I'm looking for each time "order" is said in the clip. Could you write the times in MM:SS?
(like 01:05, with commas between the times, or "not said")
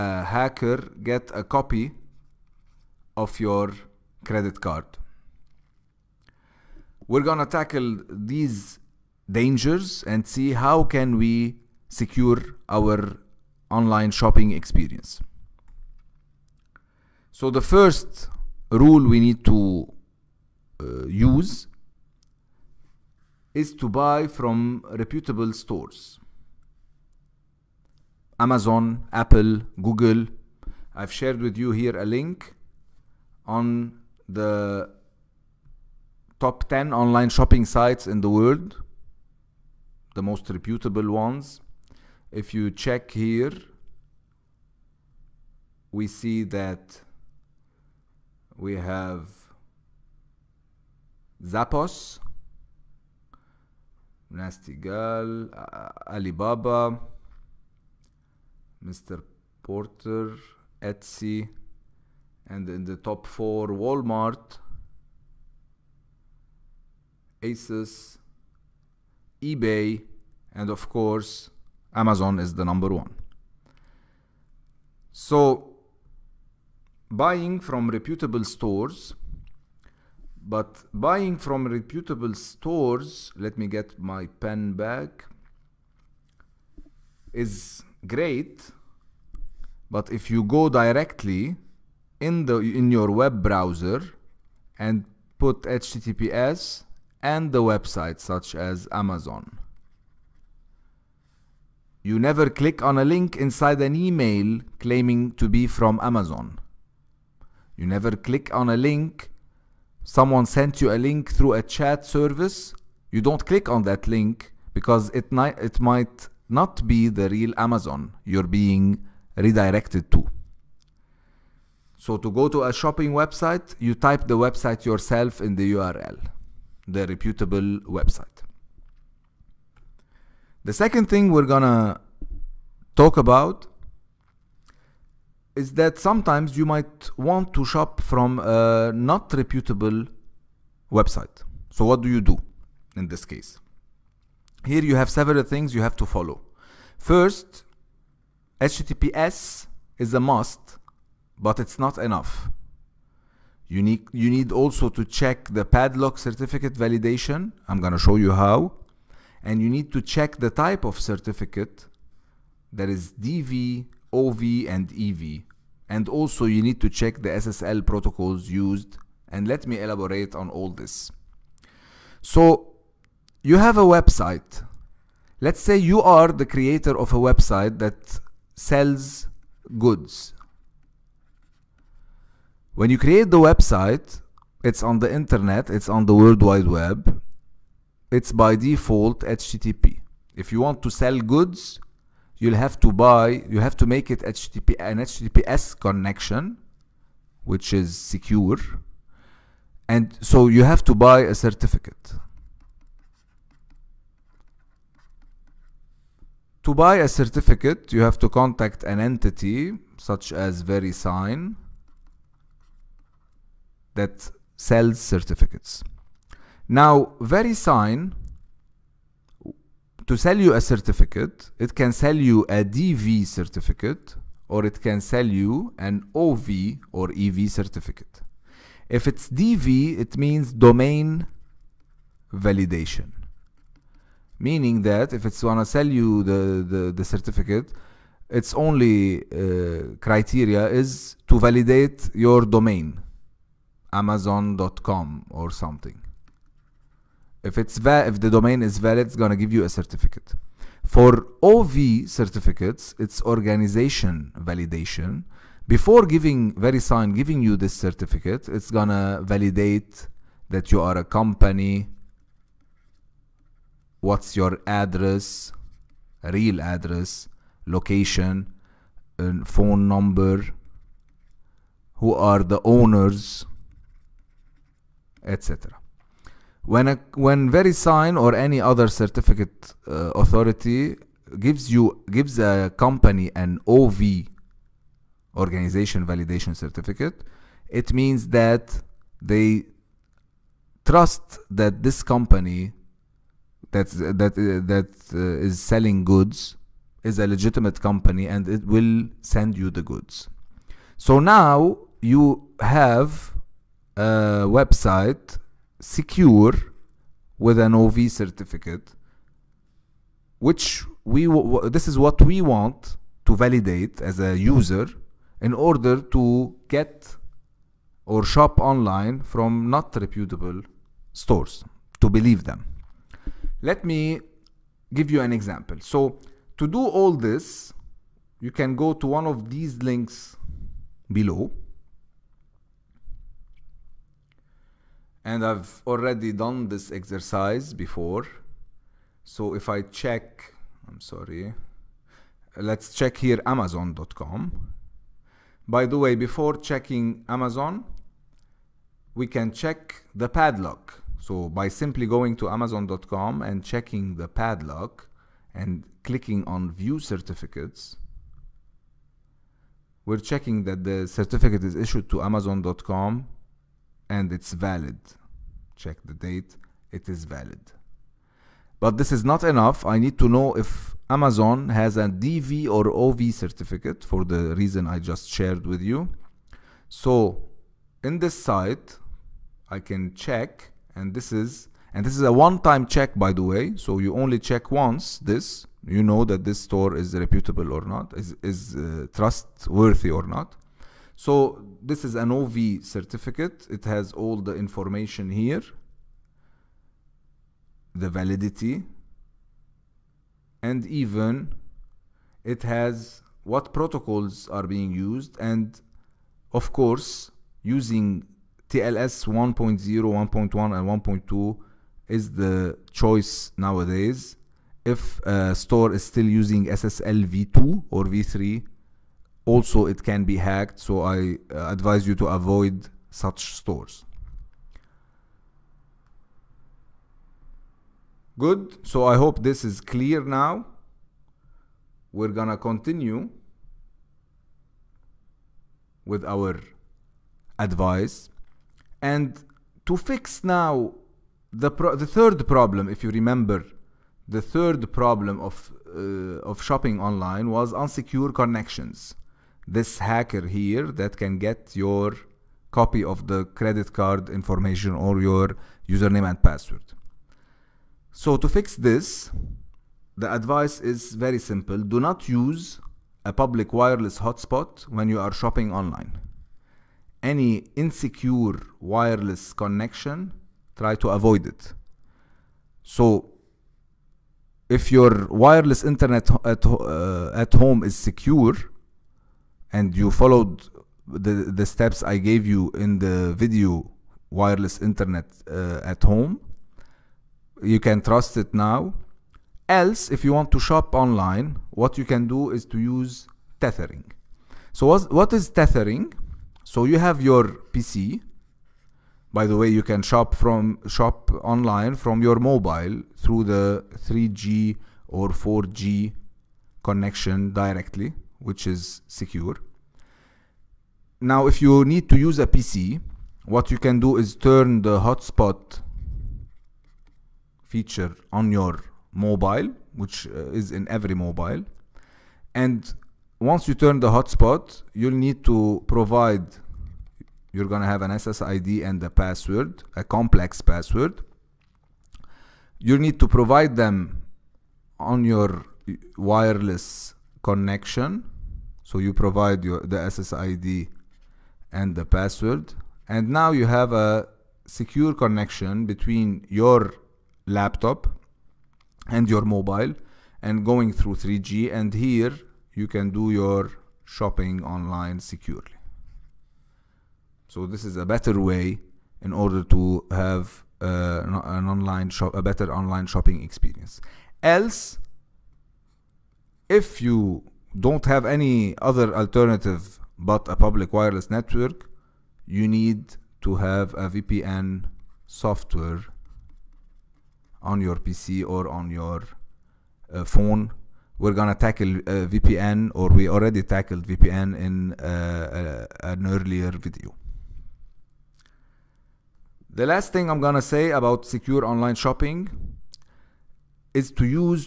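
05:15, 09:19.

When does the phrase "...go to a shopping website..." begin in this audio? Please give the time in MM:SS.
02:02.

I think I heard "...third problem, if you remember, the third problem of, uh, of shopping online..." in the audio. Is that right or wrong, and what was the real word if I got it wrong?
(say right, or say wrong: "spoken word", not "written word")
right.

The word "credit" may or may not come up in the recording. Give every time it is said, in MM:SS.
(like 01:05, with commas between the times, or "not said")
00:04, 07:33.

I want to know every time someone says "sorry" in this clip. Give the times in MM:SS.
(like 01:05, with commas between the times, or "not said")
05:40.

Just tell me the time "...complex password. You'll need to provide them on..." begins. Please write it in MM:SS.
08:50.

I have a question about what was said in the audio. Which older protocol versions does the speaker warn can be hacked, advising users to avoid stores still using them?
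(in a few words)
SSL v2 or v3.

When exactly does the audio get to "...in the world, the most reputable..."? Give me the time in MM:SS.
00:38.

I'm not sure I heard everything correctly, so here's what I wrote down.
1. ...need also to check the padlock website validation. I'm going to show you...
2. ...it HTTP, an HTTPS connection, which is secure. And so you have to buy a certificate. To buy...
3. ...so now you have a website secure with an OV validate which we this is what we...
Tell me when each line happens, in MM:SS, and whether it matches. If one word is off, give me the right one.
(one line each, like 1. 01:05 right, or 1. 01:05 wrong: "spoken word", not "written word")
1. 02:34 wrong: "certificate", not "website"
2. 03:14 right
3. 05:01 wrong: "certificate", not "validate".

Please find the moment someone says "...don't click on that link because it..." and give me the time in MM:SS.
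01:53.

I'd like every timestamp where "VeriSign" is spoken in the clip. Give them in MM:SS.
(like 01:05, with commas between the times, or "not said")
03:30, 03:37, 04:16, 04:37.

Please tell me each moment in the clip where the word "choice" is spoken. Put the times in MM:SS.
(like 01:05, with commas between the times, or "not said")
06:52.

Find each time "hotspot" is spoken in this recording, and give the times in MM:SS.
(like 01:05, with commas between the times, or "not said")
07:44, 08:34, 08:44.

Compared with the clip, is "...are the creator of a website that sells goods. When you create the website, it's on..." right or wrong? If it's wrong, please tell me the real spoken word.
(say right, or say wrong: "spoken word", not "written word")
right.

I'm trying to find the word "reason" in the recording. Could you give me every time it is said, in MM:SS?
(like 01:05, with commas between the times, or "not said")
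06:14.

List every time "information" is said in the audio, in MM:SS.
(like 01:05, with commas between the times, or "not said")
06:34, 07:34.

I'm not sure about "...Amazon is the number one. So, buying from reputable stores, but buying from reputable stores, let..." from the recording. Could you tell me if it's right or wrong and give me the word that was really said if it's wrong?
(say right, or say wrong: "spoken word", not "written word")
right.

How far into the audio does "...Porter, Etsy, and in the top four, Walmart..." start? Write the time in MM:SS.
00:59.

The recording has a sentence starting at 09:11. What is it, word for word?
And here you can do your shopping online securely.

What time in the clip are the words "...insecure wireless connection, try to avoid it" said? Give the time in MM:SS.
07:47.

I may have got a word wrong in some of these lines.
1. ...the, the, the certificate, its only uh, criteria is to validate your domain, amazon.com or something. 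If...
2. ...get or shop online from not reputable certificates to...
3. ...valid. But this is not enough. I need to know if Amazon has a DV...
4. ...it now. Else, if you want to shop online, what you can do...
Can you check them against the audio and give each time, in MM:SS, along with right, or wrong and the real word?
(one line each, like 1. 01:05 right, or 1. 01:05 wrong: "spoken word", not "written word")
1. 03:56 right
2. 05:16 wrong: "stores", not "certificates"
3. 06:07 right
4. 08:08 right.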